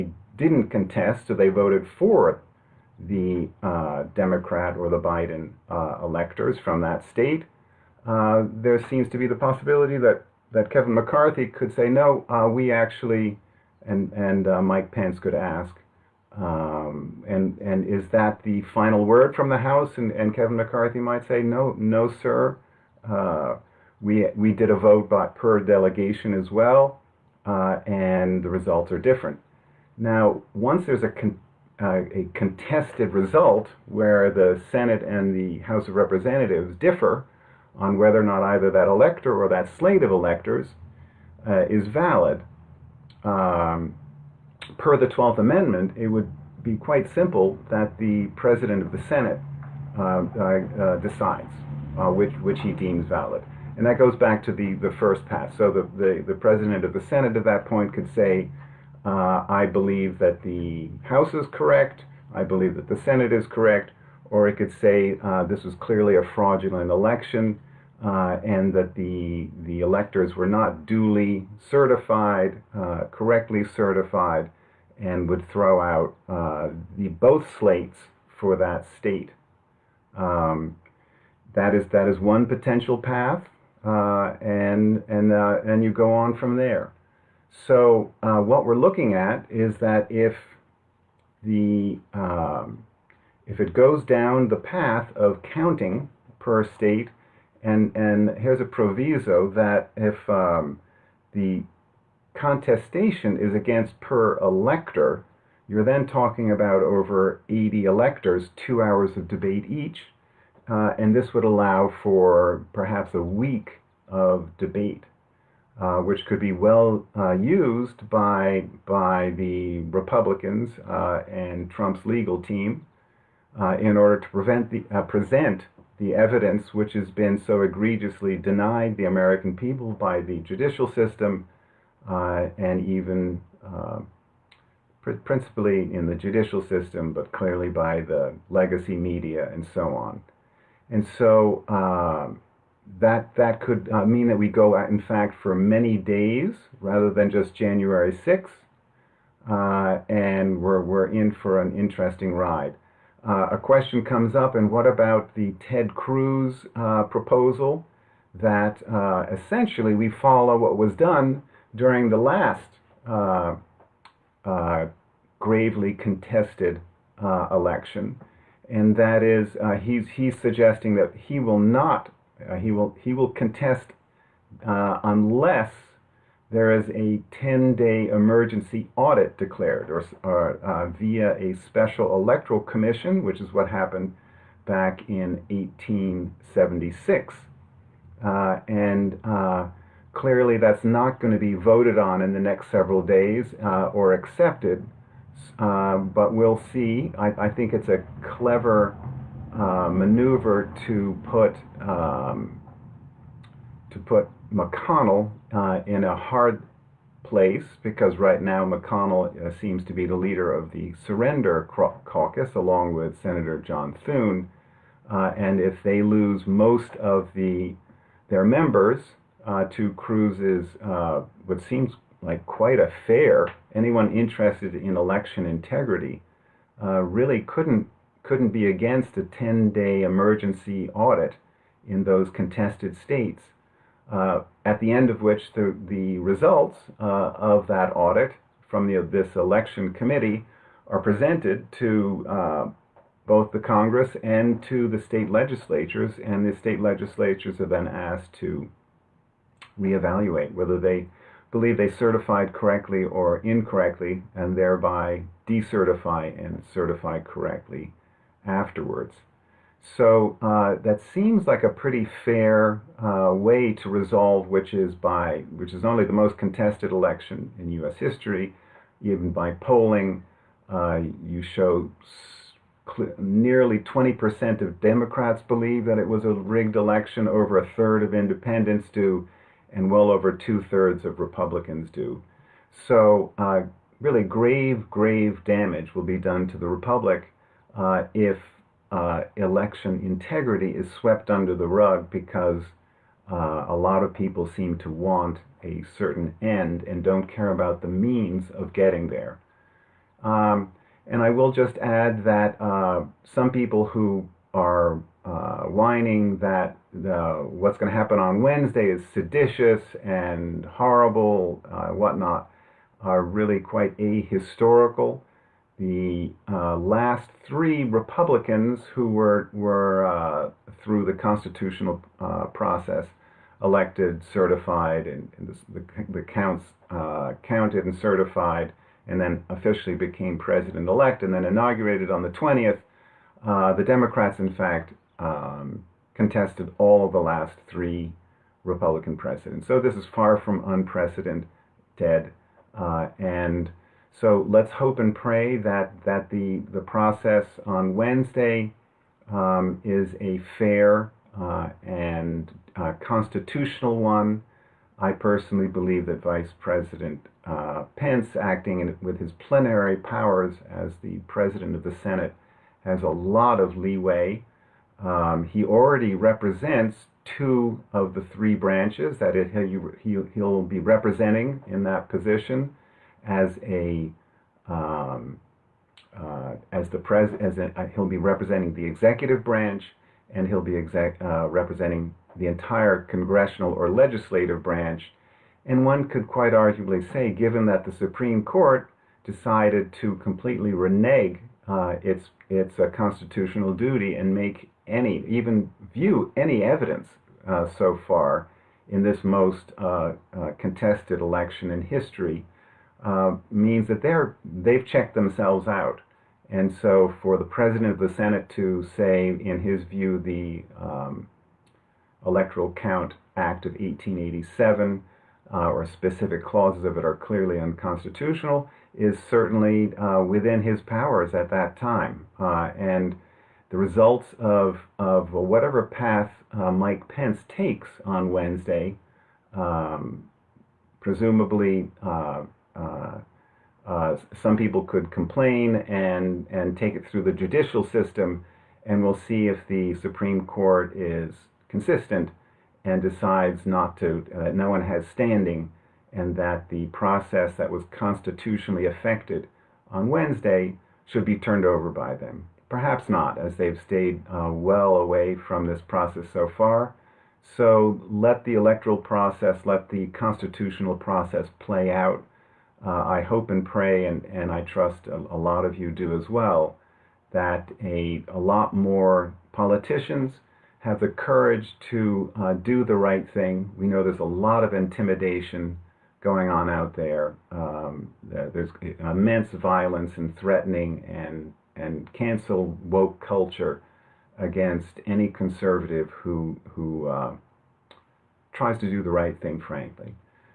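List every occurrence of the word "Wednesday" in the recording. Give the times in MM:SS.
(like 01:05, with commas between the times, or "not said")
05:08, 05:47, 07:08, 07:30.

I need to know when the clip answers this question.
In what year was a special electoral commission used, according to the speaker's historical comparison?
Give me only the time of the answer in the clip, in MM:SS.
03:05.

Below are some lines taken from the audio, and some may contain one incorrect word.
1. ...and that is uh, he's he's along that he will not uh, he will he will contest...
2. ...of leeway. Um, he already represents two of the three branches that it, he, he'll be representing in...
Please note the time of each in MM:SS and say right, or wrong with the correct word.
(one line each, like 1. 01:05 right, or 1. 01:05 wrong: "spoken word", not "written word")
1. 02:48 wrong: "suggesting", not "along"
2. 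06:03 right.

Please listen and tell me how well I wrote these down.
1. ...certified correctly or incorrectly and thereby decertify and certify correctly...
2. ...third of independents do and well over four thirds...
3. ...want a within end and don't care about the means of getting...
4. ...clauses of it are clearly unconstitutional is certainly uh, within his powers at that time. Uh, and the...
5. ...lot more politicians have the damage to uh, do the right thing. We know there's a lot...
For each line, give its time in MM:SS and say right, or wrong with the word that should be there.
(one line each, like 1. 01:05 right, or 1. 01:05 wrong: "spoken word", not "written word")
1. 04:11 right
2. 04:37 wrong: "two", not "four"
3. 04:54 wrong: "certain", not "within"
4. 06:56 right
5. 07:48 wrong: "courage", not "damage".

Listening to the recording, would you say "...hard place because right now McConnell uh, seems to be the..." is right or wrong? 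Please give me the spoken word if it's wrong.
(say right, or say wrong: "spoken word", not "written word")
right.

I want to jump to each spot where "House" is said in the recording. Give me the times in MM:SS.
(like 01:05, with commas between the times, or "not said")
00:19, 00:35, 01:01.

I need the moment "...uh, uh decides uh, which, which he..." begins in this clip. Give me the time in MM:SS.
00:50.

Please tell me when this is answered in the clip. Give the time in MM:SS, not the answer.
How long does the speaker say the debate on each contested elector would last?
01:48.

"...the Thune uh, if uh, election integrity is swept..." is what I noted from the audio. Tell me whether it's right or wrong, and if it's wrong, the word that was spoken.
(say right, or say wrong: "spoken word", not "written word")
wrong: "Republic", not "Thune".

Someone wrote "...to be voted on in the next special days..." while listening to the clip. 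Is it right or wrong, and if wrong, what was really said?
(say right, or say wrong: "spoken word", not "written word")
wrong: "several", not "special".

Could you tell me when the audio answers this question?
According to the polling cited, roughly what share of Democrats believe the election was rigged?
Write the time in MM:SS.
04:33.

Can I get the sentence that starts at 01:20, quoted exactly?
Um, that is that is one potential path, uh, and and uh, and you go on from there.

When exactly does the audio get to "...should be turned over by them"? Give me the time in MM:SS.
07:31.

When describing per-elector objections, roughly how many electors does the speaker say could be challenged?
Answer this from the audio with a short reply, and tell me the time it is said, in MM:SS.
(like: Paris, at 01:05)
over 80, at 01:46.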